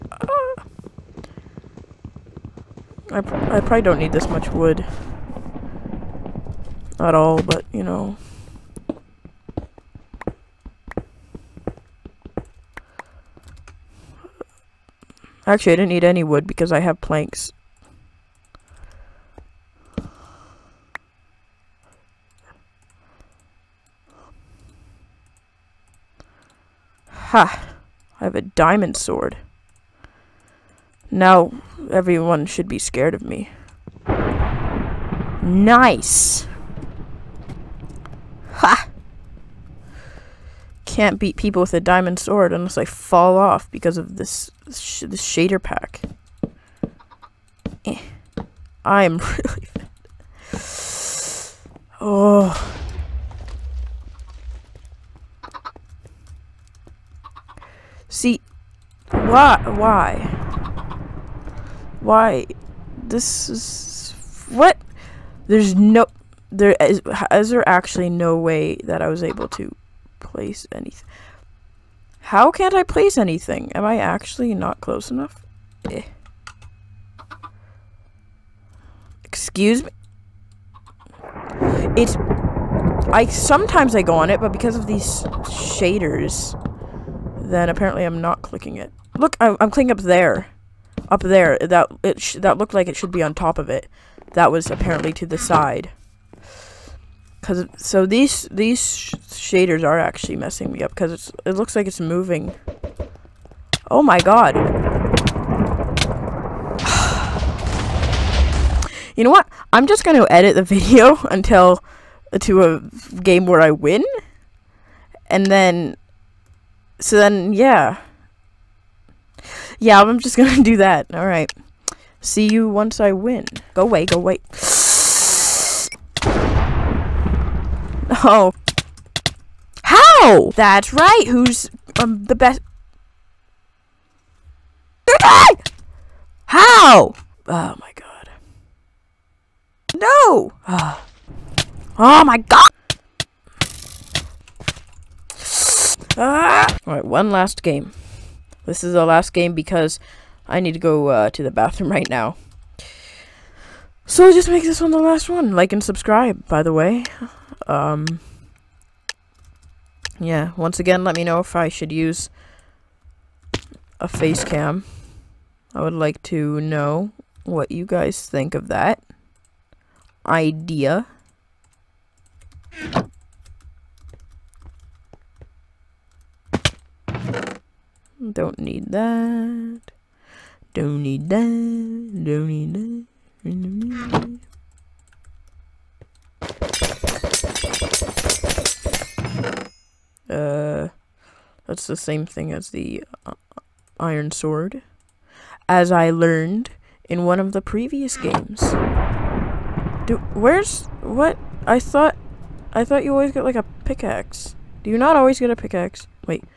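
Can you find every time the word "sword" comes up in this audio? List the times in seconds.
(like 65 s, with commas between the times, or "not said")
28 s, 42 s, 194 s.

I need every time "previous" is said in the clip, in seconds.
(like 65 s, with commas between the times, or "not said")
197 s.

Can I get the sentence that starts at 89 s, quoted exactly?
Look, I'm, I'm clicking up there.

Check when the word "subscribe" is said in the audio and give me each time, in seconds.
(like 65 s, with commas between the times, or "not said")
155 s.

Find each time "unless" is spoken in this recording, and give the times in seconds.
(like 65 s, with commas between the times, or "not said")
42 s.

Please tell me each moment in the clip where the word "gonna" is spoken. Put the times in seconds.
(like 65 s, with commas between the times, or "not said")
110 s, 120 s.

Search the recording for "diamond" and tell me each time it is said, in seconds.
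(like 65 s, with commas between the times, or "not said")
28 s, 41 s.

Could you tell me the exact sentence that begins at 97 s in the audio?
Cause so these these sh shaders are actually messing me up because it's it looks like it's moving.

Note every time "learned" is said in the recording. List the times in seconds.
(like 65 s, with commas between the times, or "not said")
196 s.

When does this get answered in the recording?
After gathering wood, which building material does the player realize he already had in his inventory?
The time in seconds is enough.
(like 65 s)
17 s.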